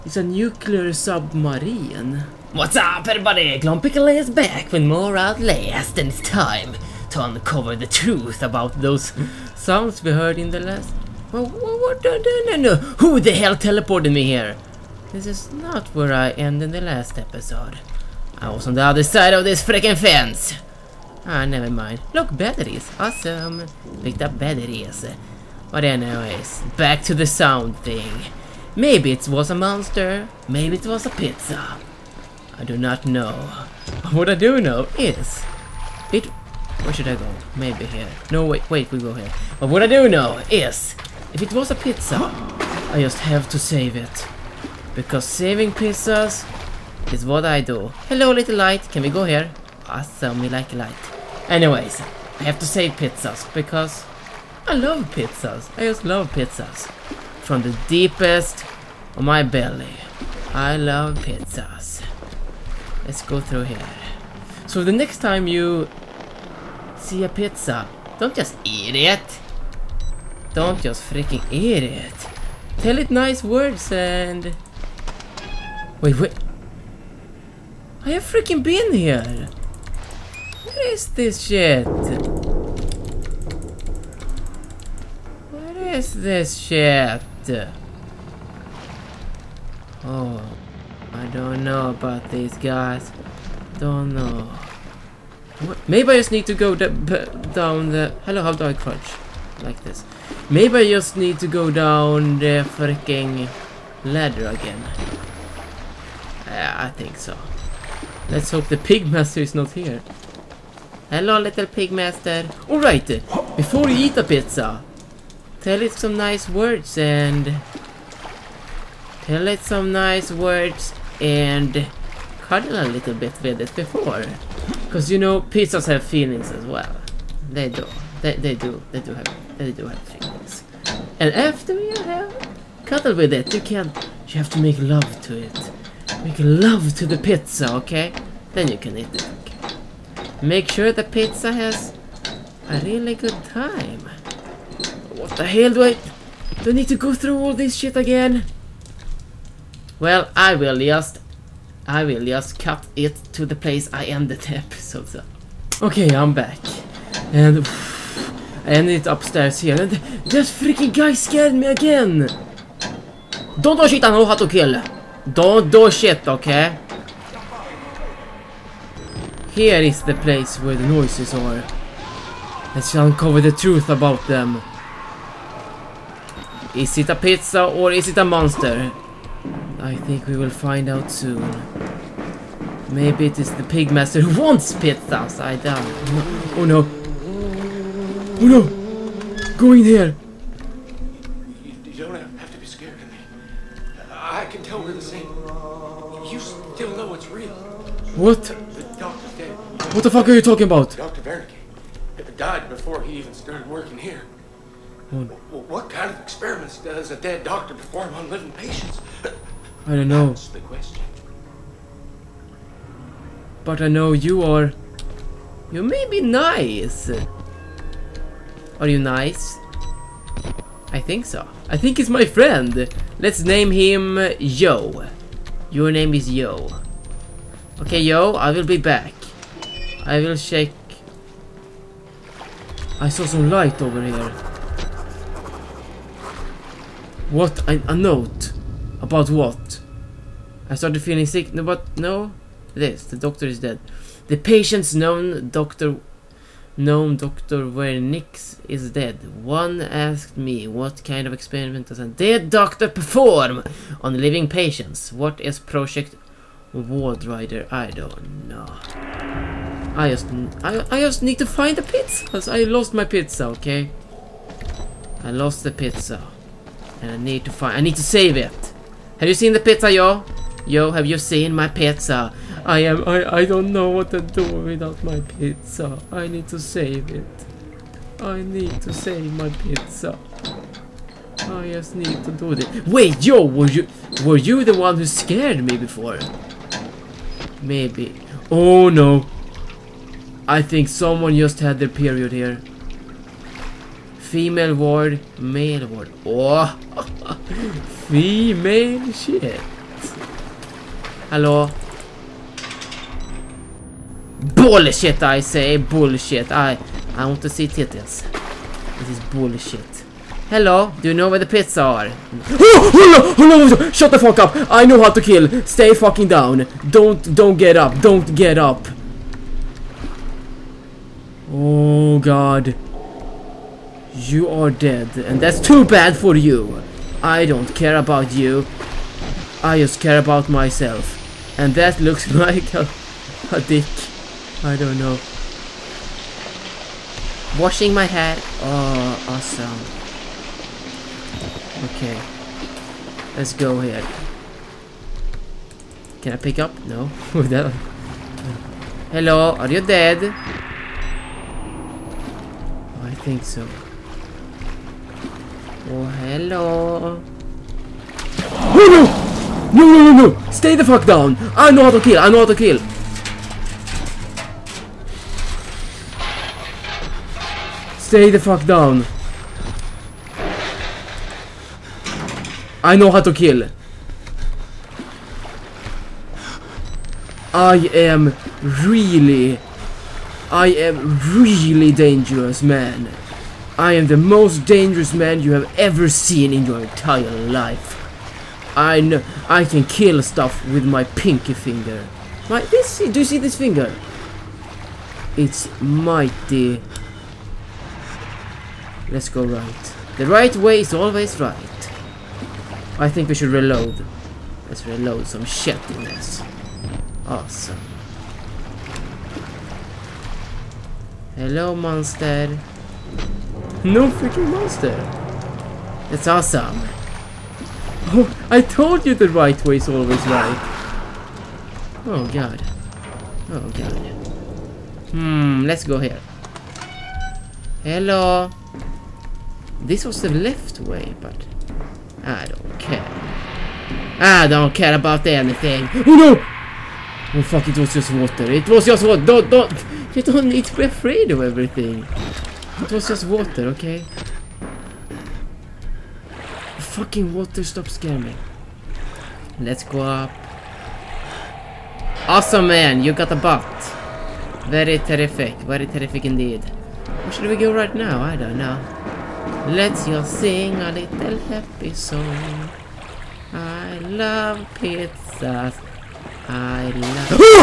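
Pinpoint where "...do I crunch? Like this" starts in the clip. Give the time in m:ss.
1:38.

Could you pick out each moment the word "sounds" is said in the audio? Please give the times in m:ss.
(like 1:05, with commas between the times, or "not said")
0:09, 0:27.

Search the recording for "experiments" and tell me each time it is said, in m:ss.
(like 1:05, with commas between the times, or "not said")
3:26, 4:11.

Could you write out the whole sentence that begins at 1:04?
So the next time you see a pizza, don't just eat it.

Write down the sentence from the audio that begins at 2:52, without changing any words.
Let's uncover the truth about them.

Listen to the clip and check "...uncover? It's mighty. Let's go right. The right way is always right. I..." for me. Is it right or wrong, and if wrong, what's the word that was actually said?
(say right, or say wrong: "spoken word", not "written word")
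wrong: "finger", not "uncover".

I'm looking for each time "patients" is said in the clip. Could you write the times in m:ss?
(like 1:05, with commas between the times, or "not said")
3:28, 4:04, 4:14.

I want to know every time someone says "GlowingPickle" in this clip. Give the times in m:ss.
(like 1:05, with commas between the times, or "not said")
0:03.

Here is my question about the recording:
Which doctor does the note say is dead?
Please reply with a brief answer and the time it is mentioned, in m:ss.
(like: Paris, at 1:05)
Doctor Nix, at 4:07.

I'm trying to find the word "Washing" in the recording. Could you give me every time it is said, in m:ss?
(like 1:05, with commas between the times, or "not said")
5:37.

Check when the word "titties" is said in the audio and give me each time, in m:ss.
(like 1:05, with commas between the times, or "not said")
5:07.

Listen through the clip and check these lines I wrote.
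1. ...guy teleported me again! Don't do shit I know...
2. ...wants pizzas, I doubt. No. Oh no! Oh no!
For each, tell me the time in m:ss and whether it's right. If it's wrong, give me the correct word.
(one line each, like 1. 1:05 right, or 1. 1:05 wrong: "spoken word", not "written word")
1. 2:40 wrong: "scared", not "teleported"
2. 3:04 right.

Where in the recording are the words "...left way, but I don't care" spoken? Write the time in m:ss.
7:10.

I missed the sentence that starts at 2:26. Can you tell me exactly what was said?
Do I need to go through all this shit again?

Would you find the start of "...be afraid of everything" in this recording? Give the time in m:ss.
7:20.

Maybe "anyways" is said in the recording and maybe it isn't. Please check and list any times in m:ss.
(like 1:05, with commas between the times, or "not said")
0:25, 0:51.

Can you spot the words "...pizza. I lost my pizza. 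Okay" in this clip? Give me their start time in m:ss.
4:21.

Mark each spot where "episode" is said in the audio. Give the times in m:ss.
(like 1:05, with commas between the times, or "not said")
0:17, 2:34.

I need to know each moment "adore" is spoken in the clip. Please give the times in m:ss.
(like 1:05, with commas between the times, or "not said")
not said.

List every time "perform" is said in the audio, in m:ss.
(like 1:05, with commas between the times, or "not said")
3:27, 4:12.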